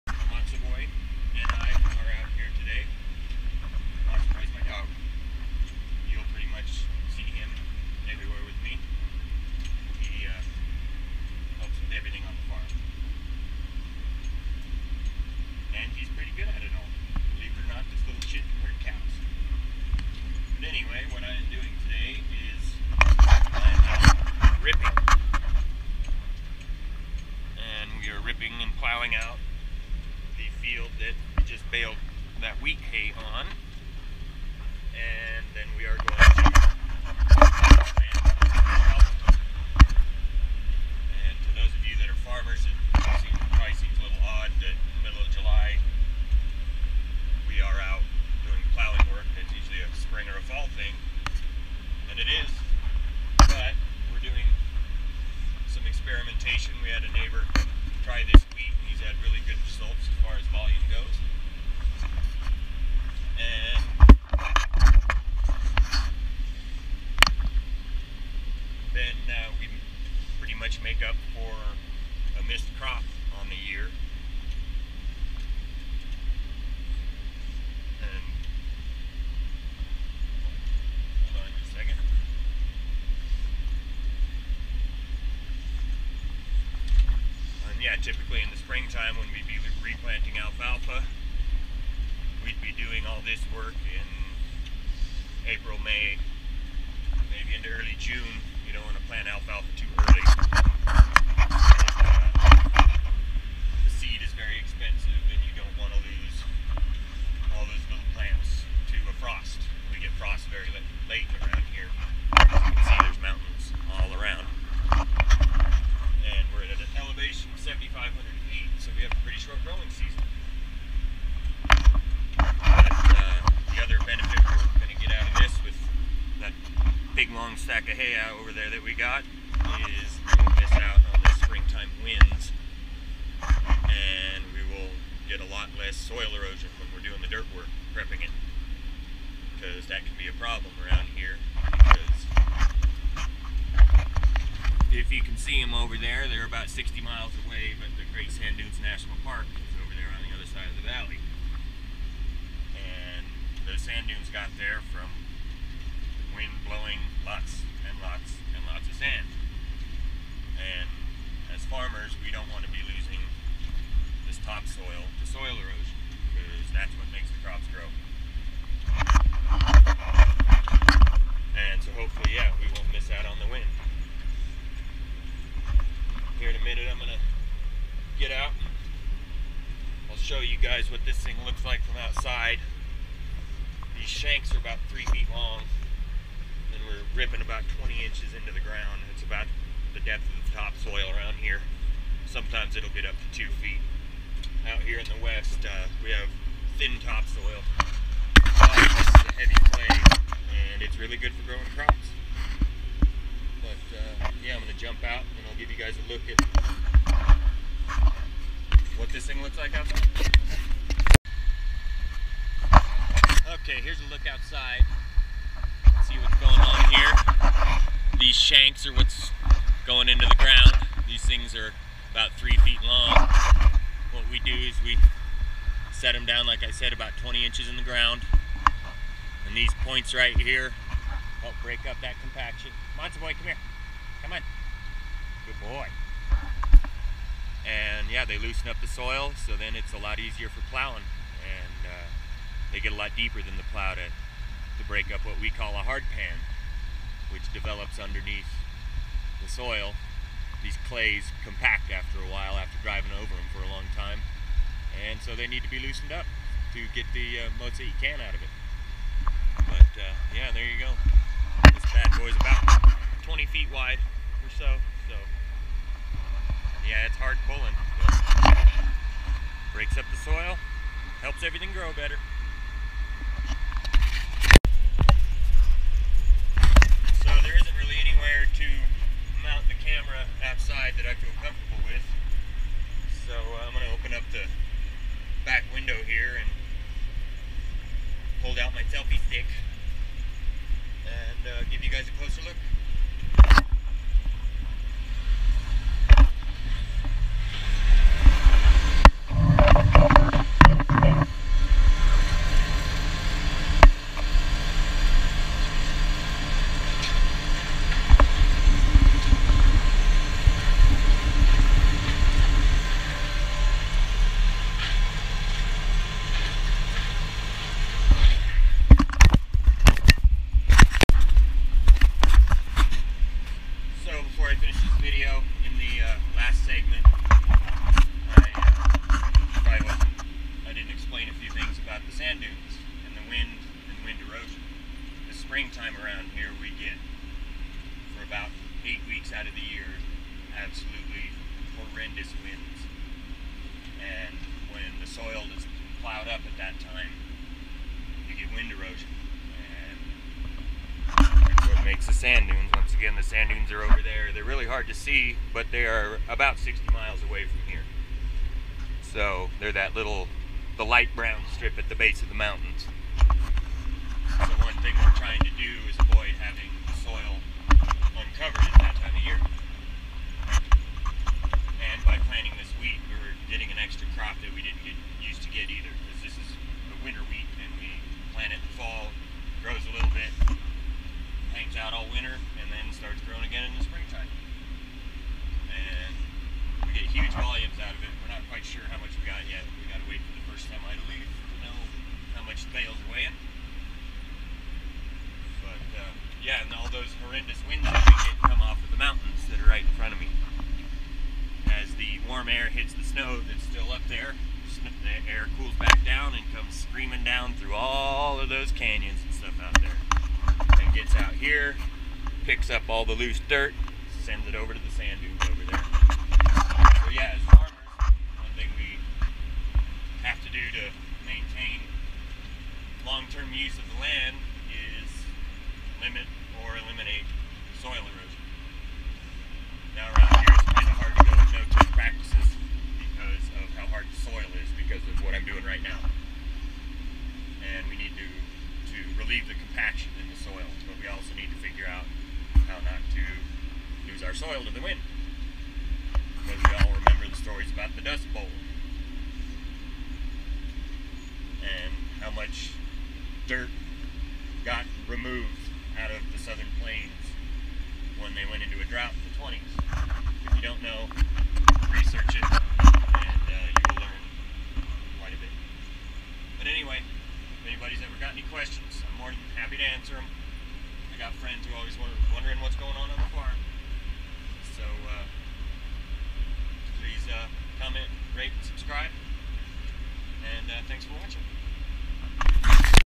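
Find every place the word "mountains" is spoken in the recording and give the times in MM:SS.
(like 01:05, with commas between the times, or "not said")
06:02, 06:38.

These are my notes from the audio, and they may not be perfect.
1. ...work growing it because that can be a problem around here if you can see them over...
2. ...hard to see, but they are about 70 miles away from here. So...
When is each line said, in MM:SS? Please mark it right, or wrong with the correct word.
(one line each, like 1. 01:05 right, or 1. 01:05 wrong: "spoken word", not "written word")
1. 02:17 wrong: "prepping", not "growing"
2. 05:54 wrong: "60", not "70".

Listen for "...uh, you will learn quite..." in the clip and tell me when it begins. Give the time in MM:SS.
07:43.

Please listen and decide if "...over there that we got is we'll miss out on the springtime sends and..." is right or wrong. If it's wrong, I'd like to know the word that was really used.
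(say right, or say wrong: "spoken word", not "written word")
wrong: "winds", not "sends".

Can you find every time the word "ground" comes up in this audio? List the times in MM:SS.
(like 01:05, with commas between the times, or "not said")
03:08, 03:40, 03:47.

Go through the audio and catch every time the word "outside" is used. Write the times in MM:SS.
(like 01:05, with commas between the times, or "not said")
03:02, 03:29, 03:34, 04:40.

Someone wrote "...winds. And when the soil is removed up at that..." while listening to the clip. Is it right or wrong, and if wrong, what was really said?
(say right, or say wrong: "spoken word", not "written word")
wrong: "plowed", not "removed".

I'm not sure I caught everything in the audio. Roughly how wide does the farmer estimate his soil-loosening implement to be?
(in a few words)
20 feet.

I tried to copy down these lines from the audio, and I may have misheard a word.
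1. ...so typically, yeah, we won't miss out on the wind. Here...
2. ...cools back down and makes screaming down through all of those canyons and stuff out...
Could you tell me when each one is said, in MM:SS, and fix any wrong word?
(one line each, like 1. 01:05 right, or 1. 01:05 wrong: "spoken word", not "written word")
1. 02:51 wrong: "hopefully", not "typically"
2. 06:45 wrong: "comes", not "makes".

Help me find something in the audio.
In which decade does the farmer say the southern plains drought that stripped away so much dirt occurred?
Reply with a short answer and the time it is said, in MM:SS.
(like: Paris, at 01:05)
the 1920s, at 07:39.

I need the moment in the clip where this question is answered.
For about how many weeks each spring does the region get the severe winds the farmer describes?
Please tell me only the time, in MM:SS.
05:38.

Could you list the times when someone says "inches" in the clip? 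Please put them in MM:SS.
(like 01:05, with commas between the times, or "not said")
03:08, 03:47.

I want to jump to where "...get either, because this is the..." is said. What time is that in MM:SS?
06:15.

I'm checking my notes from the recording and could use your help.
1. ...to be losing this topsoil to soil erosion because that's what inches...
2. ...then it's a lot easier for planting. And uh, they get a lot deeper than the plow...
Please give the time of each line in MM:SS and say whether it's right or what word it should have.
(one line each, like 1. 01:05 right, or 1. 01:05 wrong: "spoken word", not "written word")
1. 02:42 wrong: "makes", not "inches"
2. 03:59 wrong: "plowing", not "planting".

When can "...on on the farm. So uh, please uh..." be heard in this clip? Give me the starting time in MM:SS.
07:52.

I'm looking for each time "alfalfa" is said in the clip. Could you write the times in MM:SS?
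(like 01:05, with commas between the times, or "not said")
01:30, 01:39.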